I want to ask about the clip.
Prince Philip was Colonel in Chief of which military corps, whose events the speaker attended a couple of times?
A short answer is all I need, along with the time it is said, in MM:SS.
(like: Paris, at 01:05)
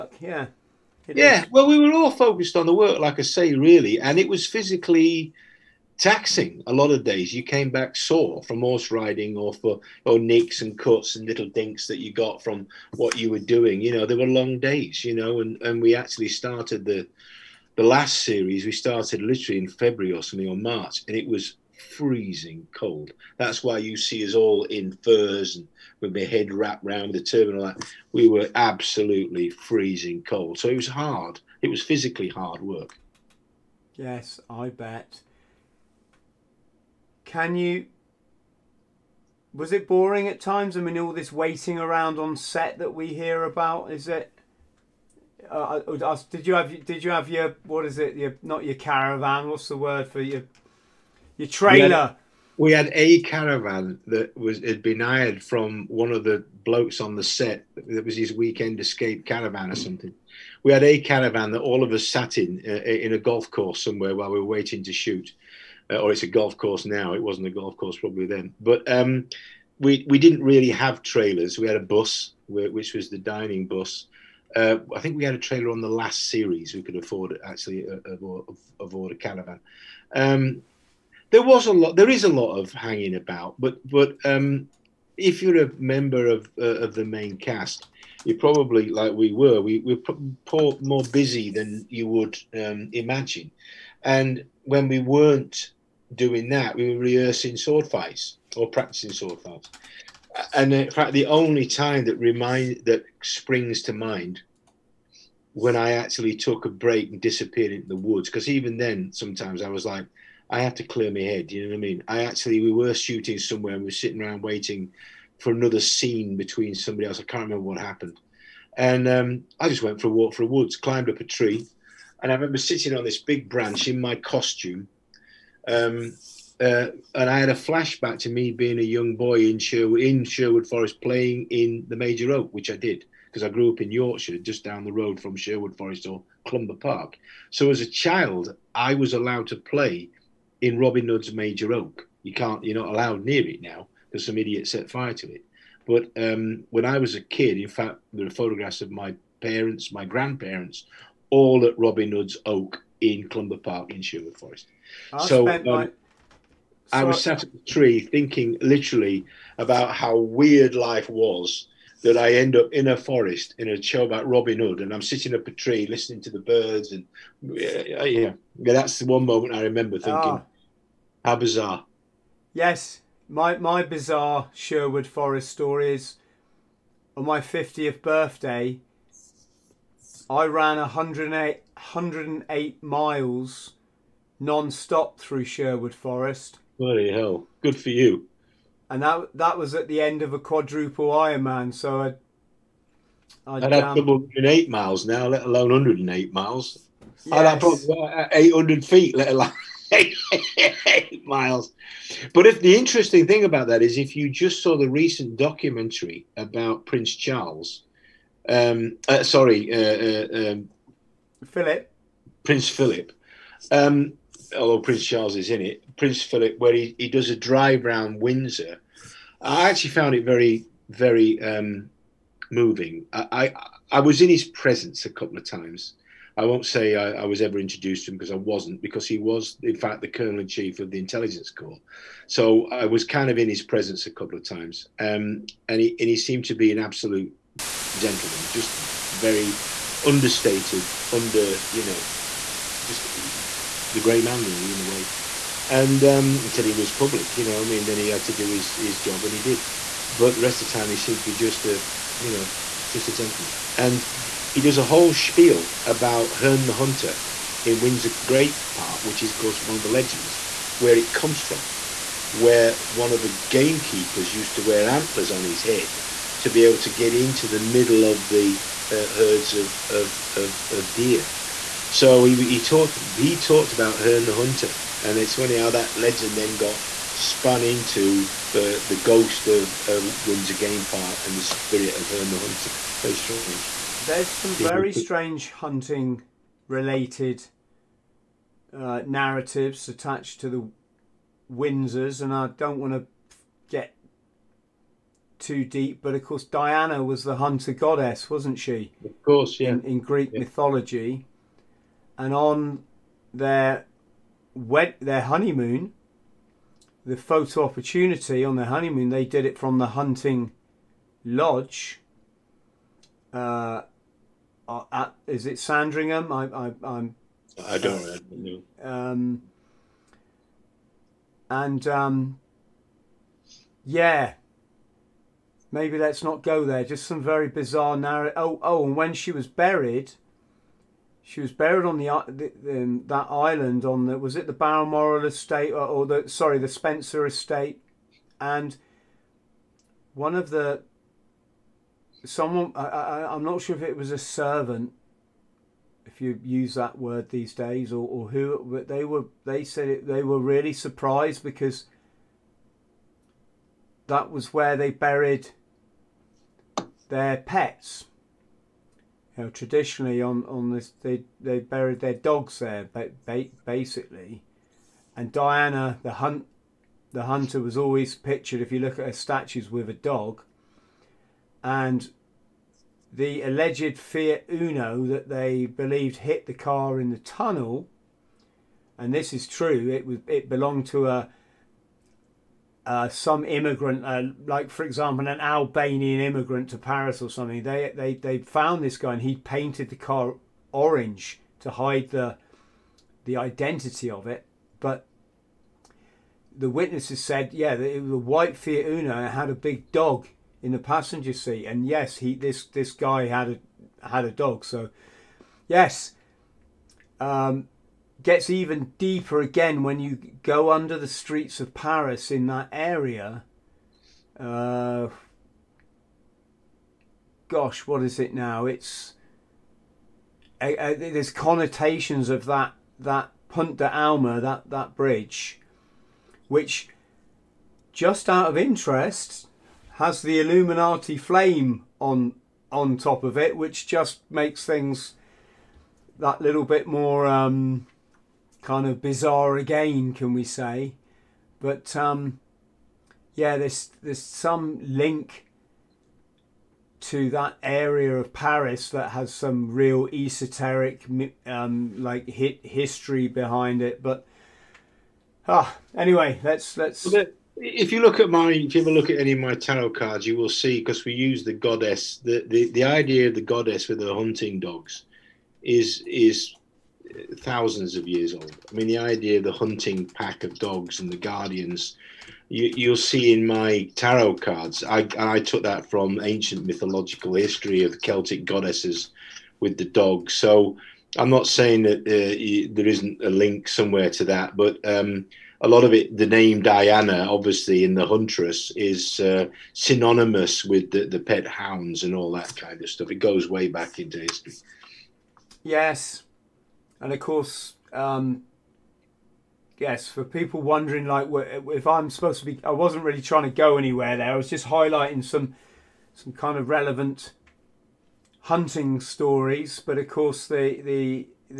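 Intelligence Corps, at 03:50.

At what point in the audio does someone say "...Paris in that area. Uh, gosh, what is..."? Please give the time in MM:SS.
06:51.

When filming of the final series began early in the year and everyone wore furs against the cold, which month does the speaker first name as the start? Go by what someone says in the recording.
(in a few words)
February.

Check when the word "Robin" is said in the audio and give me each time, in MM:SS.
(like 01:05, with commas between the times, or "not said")
02:20, 02:31, 02:44.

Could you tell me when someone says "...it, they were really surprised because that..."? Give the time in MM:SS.
05:49.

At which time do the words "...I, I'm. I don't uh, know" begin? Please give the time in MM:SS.
05:16.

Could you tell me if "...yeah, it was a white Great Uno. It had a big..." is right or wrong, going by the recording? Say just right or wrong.
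wrong.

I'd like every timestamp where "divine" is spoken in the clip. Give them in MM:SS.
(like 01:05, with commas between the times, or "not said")
not said.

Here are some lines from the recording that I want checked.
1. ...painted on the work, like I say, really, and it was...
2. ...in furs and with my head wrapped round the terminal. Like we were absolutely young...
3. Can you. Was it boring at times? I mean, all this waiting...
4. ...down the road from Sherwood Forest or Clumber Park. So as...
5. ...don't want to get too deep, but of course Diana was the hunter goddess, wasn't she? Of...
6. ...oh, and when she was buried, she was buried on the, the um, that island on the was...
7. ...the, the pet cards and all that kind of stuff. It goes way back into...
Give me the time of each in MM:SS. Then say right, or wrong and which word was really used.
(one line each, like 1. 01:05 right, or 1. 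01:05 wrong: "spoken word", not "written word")
1. 00:02 wrong: "focused", not "painted"
2. 00:24 wrong: "freezing", not "young"
3. 00:37 right
4. 02:14 right
5. 04:52 right
6. 05:28 right
7. 08:10 wrong: "hounds", not "cards".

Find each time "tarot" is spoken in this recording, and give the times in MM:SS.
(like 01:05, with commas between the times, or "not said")
07:39, 07:53.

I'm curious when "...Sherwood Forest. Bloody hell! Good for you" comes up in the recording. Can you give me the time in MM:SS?
03:05.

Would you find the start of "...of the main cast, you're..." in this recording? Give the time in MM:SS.
01:26.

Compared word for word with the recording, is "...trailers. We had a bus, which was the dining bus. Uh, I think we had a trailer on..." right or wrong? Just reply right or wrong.
right.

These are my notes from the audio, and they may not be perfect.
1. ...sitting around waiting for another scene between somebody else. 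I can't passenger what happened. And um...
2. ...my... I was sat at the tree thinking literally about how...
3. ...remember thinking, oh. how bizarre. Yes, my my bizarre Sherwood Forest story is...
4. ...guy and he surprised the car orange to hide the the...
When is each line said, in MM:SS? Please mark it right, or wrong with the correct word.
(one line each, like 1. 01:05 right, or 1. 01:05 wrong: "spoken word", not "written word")
1. 01:53 wrong: "remember", not "passenger"
2. 02:35 right
3. 02:49 right
4. 06:28 wrong: "painted", not "surprised".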